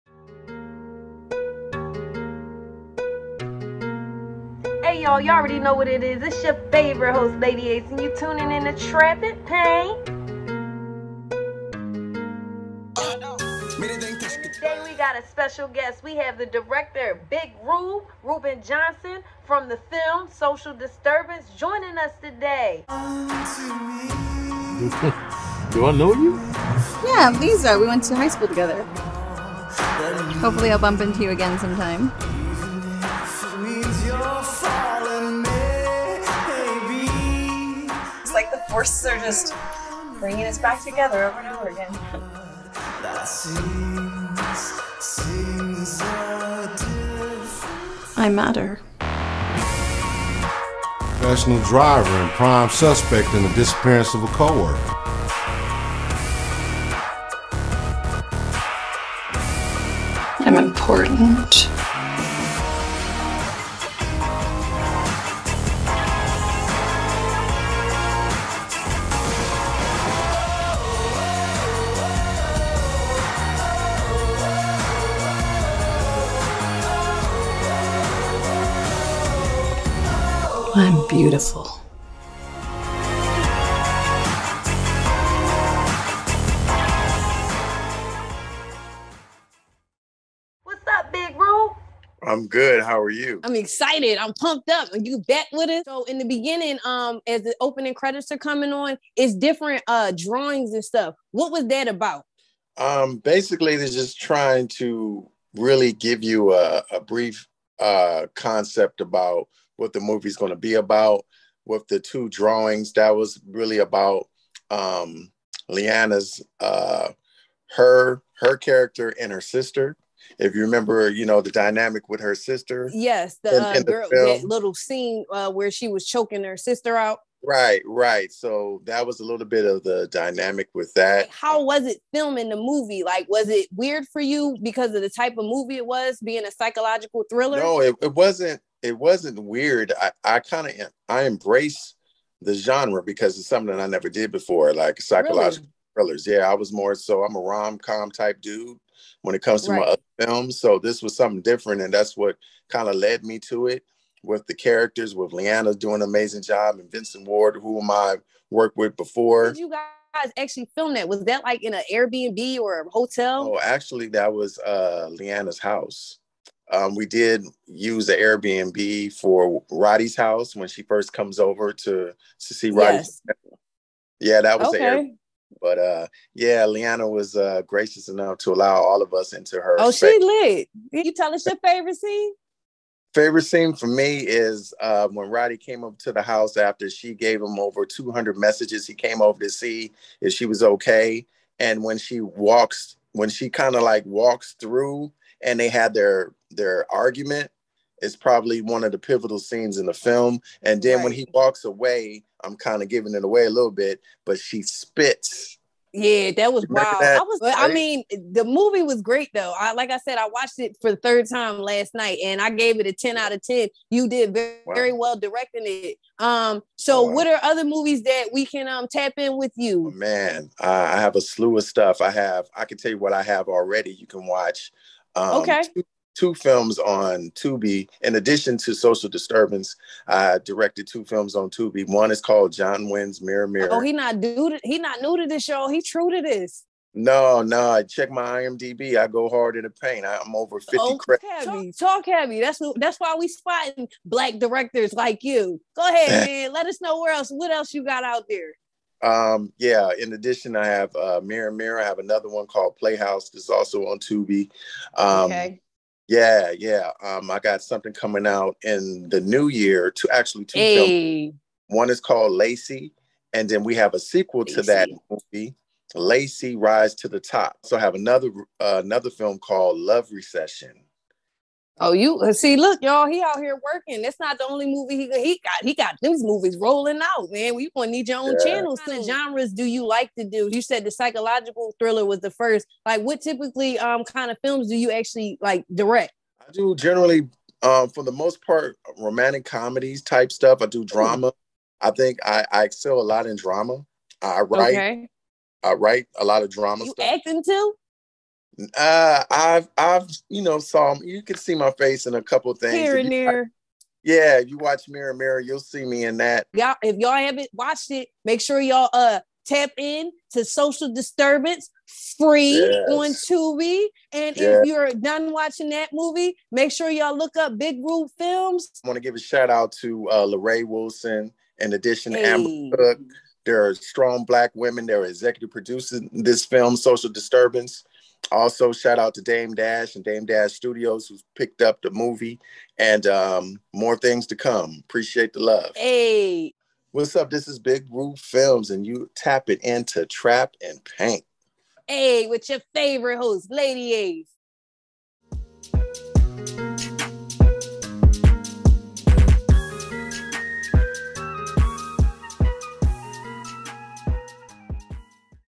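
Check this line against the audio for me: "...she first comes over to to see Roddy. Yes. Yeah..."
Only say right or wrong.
right.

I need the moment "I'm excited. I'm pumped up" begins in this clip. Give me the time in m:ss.
1:33.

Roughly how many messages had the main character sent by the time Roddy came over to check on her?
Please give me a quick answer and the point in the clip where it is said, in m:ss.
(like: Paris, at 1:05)
Over 200, at 3:07.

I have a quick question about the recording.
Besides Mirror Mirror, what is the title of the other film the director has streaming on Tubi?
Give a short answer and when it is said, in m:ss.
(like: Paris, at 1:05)
Playhouse, at 4:12.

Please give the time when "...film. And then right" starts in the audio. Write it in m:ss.
3:19.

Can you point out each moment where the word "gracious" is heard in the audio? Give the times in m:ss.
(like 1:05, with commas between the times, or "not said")
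2:57.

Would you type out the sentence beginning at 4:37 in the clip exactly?
We gonna need your own yeah.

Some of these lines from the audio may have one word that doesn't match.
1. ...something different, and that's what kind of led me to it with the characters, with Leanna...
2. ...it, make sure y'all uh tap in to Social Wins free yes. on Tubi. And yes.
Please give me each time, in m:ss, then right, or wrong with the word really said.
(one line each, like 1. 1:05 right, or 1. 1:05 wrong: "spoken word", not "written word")
1. 2:31 right
2. 5:07 wrong: "Disturbance", not "Wins".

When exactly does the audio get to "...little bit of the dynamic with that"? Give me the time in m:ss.
2:09.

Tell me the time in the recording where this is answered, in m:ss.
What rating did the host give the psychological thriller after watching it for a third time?
3:32.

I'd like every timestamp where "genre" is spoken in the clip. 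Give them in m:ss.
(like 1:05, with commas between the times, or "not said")
2:22, 4:39.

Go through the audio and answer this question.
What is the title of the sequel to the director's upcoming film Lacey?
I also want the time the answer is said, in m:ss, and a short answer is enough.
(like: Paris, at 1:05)
Lacey Rise to the Top, at 4:25.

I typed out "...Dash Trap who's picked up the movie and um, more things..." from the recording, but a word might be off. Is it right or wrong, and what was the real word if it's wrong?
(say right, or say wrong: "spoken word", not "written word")
wrong: "Studios", not "Trap".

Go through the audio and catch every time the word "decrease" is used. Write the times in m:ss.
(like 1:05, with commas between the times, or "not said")
not said.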